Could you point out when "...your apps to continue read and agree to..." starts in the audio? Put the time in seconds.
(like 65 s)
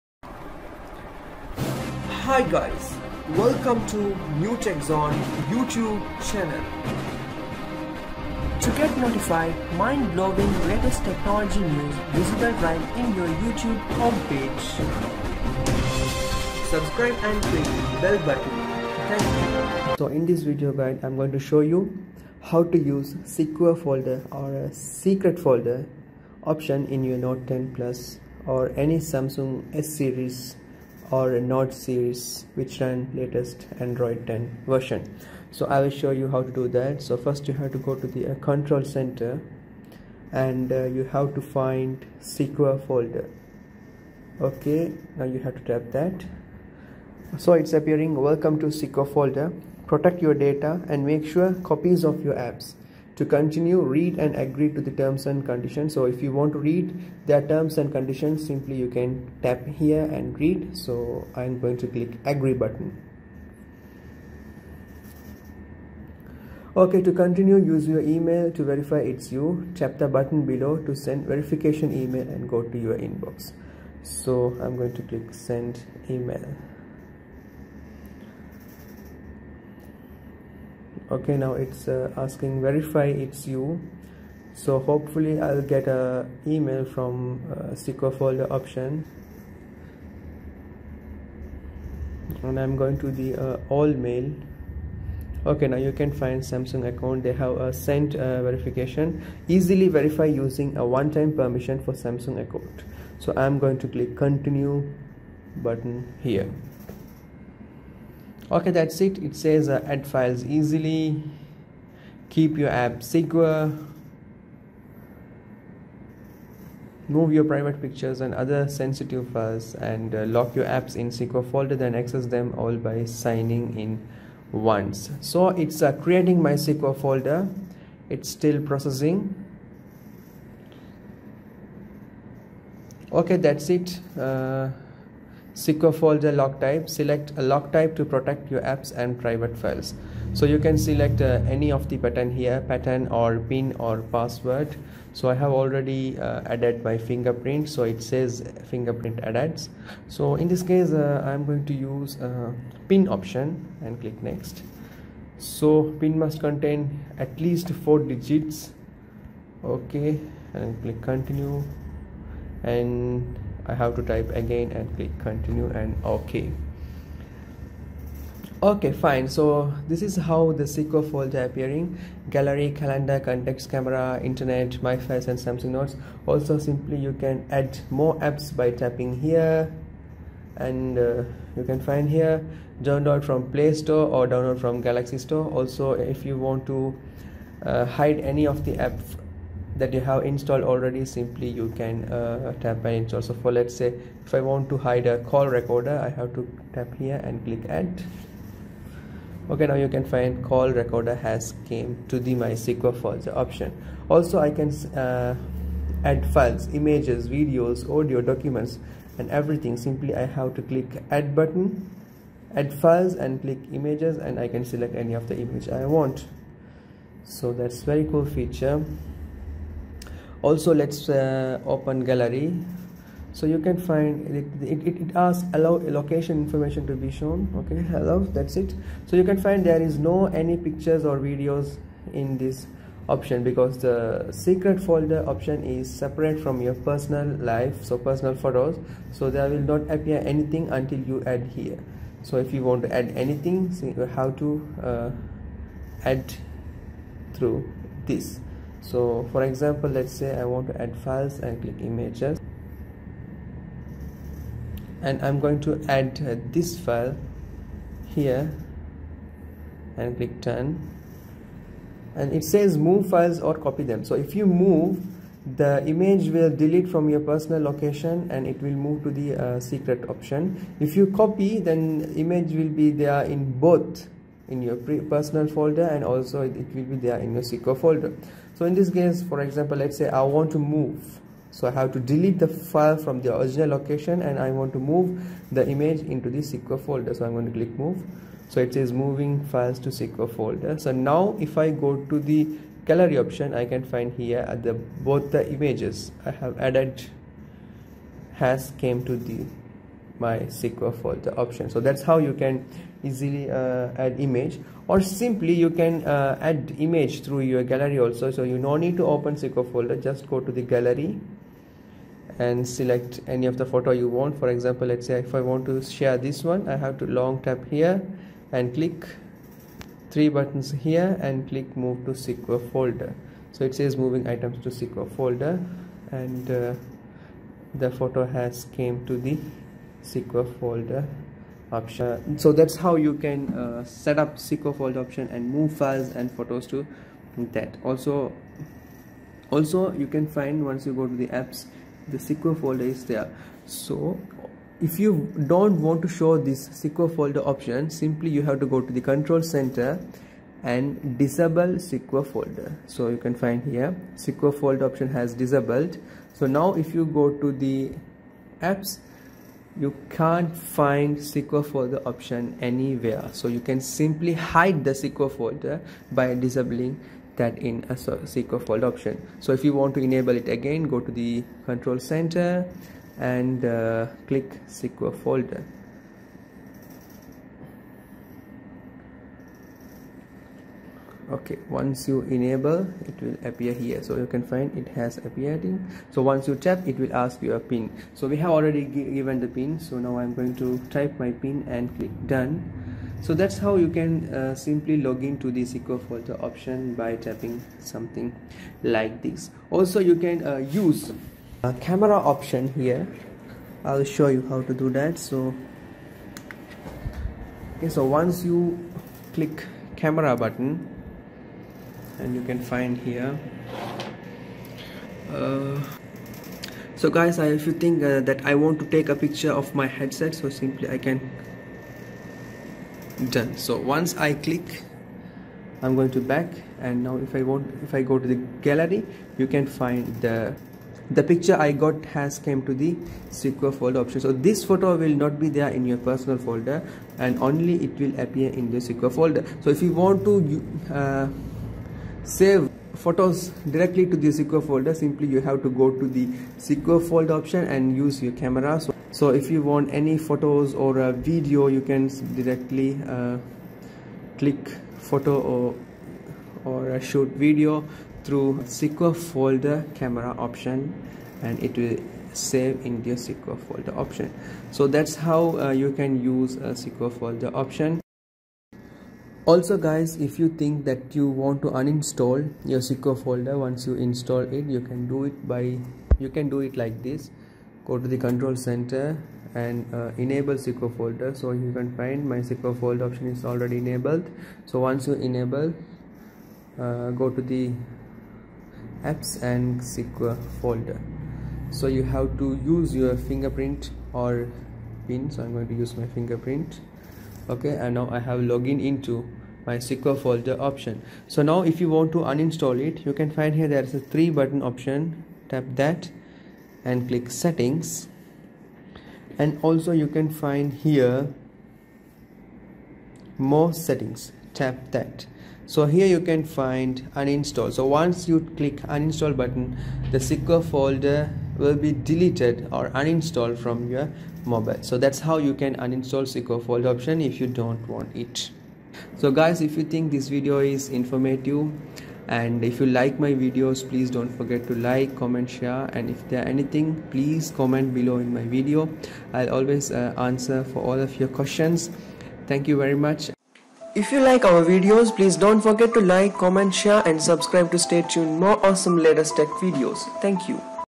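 52 s.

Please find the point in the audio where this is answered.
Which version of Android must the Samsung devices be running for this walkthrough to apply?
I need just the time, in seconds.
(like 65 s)
33 s.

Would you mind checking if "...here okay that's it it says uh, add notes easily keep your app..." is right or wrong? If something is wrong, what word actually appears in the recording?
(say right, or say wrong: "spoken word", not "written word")
wrong: "files", not "notes".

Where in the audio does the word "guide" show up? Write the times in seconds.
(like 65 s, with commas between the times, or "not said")
20 s.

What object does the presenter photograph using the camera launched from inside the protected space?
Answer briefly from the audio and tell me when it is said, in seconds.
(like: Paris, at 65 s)
headset, at 419 s.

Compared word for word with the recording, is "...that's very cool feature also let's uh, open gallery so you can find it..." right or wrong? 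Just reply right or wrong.
right.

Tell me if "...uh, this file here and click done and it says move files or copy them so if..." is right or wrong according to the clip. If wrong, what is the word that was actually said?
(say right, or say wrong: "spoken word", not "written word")
right.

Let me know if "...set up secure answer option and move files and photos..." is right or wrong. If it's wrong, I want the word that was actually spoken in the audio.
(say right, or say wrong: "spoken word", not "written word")
wrong: "folder", not "answer".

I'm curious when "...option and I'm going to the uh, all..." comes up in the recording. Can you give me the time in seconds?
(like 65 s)
88 s.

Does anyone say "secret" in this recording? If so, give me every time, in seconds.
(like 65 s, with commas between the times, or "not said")
24 s, 234 s, 269 s.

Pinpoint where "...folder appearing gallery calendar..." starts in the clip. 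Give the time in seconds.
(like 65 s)
171 s.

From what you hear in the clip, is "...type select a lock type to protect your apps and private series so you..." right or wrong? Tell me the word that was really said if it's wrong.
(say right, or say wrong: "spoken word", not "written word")
wrong: "files", not "series".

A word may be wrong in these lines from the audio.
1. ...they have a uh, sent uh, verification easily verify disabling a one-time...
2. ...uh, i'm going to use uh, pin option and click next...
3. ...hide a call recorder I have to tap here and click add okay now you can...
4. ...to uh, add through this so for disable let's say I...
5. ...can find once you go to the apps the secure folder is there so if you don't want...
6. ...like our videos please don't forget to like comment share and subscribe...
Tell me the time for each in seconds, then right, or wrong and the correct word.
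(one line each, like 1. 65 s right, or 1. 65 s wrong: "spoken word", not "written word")
1. 97 s wrong: "using", not "disabling"
2. 150 s right
3. 194 s right
4. 244 s wrong: "example", not "disable"
5. 340 s right
6. 544 s right.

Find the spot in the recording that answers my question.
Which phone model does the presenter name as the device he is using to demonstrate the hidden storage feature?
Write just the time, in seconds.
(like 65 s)
27 s.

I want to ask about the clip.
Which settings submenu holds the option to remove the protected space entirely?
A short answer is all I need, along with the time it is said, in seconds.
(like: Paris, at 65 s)
more settings, at 513 s.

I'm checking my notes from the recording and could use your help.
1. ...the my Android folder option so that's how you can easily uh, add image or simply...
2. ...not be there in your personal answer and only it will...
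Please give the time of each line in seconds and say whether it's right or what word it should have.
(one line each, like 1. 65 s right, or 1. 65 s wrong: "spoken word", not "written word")
1. 299 s wrong: "MySQL", not "Android"
2. 435 s wrong: "folder", not "answer".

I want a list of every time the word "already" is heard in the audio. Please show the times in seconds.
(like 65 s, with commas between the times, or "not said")
145 s, 190 s, 388 s, 483 s.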